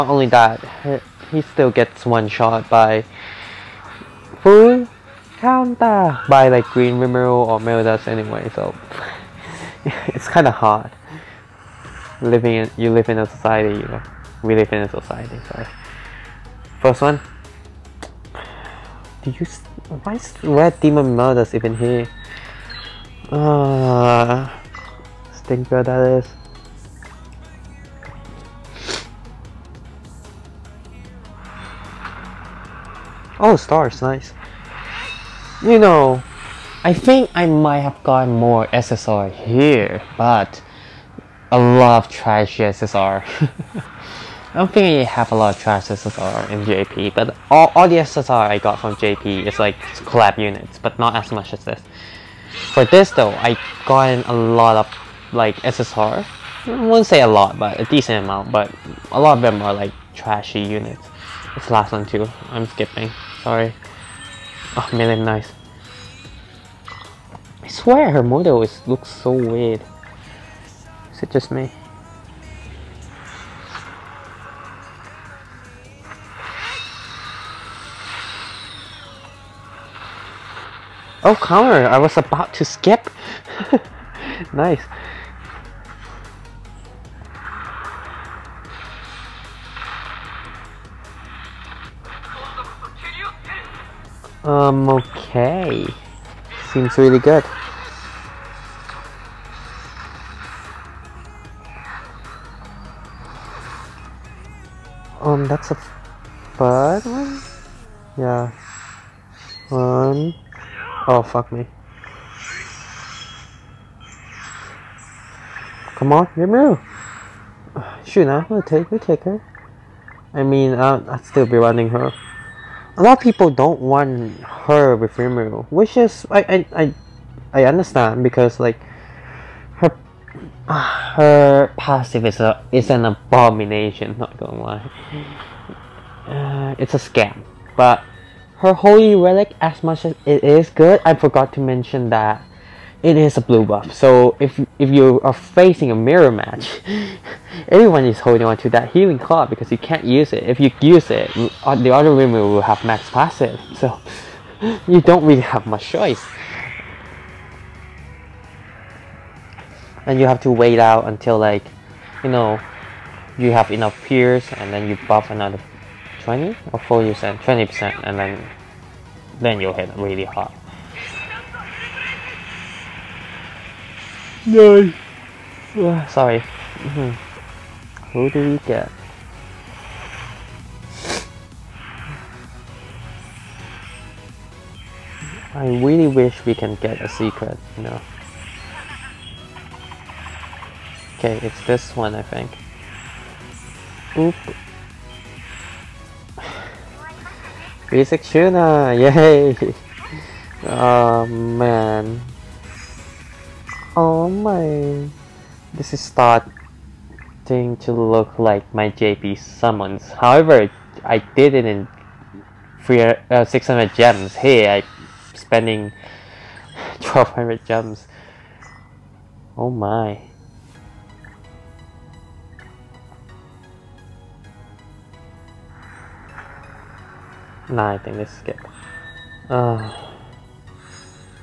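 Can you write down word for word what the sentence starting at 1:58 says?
Shoot, now we to take, we'll take her.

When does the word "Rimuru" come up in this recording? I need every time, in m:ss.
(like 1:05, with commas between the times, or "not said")
0:06, 2:05.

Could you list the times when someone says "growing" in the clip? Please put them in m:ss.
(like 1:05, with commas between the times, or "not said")
not said.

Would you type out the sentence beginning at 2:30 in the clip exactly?
If you use it, uh, the other women will have max passive.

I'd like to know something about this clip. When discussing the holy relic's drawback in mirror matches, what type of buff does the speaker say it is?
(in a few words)
blue buff.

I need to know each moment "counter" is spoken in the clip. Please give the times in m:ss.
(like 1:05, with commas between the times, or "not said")
0:05, 1:21.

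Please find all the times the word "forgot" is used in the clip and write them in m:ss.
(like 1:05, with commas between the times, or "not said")
2:21.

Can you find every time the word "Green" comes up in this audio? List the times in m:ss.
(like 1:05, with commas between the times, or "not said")
0:06.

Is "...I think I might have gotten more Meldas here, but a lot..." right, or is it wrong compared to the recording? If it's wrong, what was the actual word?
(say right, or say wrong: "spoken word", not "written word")
wrong: "SSR", not "Meldas".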